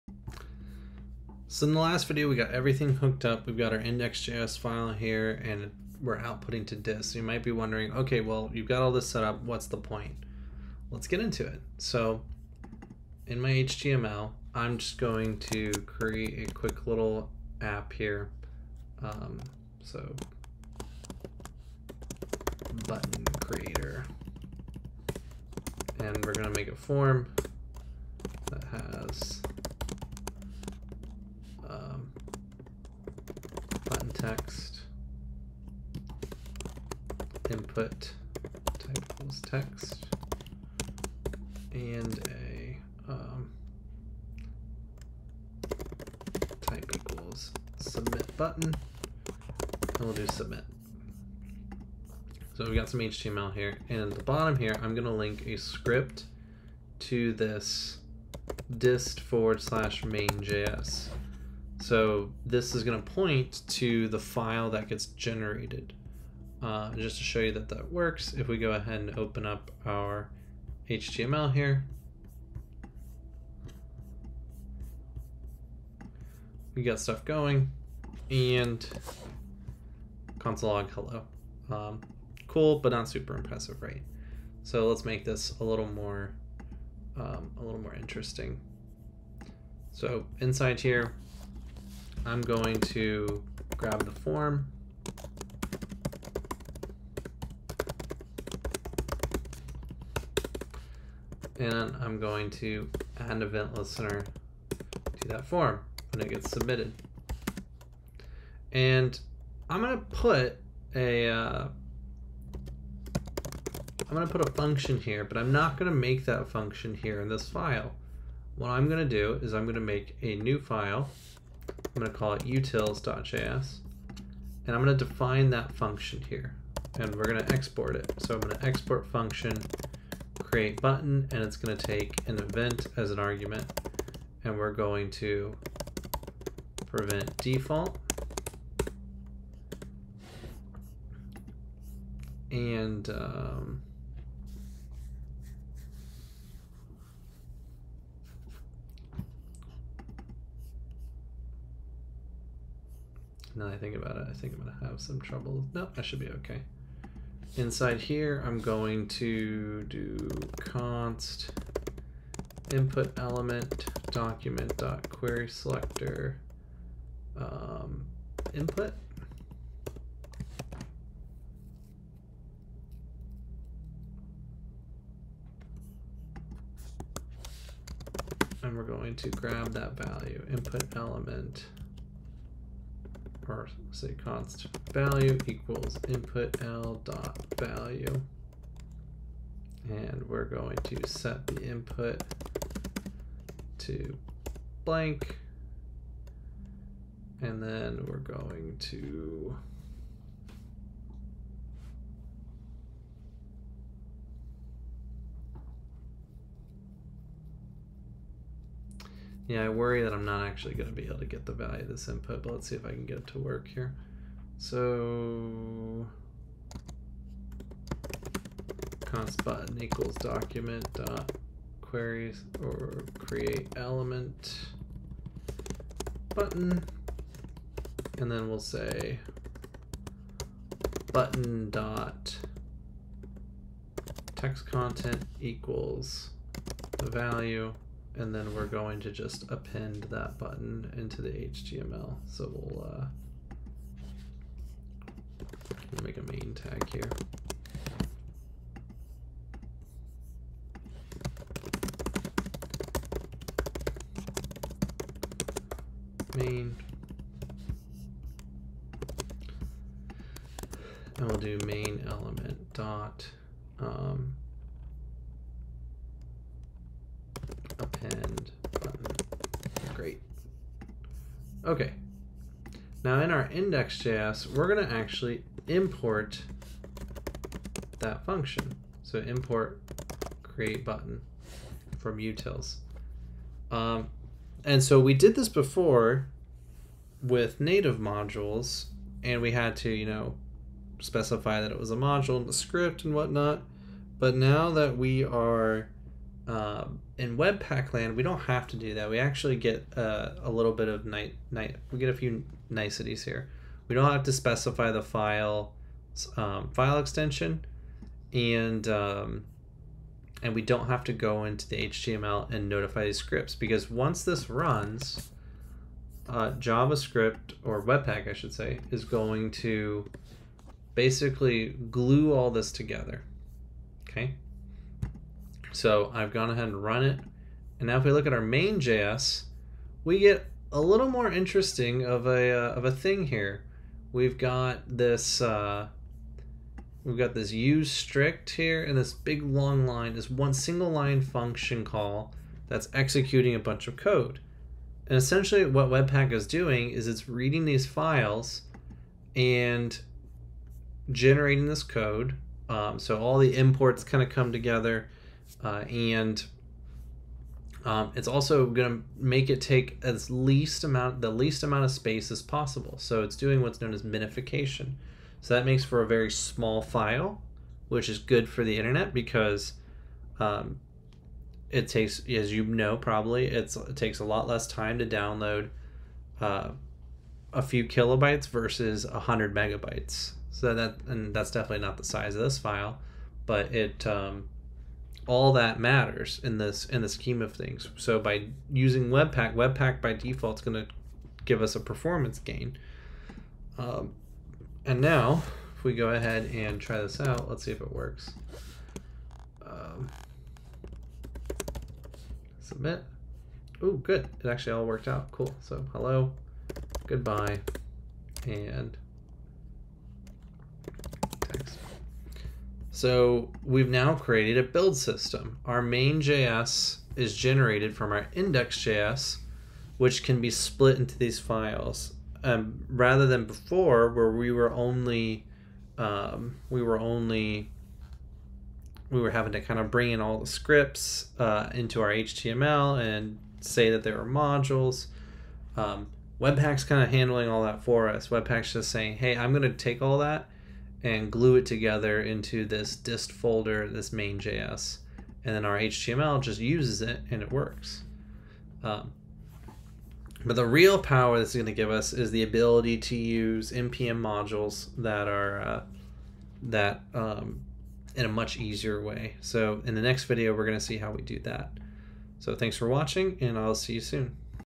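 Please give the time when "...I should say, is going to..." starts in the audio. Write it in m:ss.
5:18.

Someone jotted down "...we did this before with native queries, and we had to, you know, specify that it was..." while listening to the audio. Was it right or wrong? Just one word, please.
wrong.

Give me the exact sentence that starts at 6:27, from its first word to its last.
So by using Webpack, Webpack by default is going to give us a performance gain.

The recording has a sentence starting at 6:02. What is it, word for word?
So it's doing what's known as minification.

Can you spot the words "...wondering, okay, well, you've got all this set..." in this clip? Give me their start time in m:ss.
0:07.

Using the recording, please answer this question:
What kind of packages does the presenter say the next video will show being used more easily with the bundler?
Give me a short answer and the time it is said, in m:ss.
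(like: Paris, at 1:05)
npm modules, at 7:33.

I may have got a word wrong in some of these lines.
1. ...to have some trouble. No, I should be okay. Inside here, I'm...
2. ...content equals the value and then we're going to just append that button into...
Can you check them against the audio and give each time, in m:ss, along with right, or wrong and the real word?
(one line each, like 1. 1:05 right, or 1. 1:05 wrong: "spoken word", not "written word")
1. 2:34 right
2. 3:54 right.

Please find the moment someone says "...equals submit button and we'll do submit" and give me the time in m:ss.
0:46.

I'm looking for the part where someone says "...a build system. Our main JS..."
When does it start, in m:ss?
6:54.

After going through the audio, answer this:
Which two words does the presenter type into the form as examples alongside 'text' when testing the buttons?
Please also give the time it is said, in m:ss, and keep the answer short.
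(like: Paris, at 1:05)
hello, goodbye, at 6:45.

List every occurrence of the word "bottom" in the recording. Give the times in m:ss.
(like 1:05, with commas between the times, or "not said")
0:54.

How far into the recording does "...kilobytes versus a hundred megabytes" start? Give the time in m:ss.
6:17.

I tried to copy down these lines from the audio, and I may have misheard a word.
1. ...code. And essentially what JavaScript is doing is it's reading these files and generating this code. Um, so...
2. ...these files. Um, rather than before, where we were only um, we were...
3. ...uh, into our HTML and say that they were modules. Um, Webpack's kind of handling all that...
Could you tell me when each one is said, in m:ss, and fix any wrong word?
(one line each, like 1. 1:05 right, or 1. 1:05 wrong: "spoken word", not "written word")
1. 5:43 wrong: "Webpack", not "JavaScript"
2. 7:01 right
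3. 7:11 right.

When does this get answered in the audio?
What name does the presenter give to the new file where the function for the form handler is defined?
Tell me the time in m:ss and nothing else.
2:02.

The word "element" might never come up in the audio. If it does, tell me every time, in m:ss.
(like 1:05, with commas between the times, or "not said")
2:43, 3:00, 3:43, 4:22.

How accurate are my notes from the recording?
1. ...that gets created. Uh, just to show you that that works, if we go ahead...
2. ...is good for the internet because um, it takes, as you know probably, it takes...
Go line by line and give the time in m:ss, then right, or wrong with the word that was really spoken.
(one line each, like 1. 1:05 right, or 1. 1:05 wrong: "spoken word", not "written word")
1. 1:04 wrong: "generated", not "created"
2. 6:08 right.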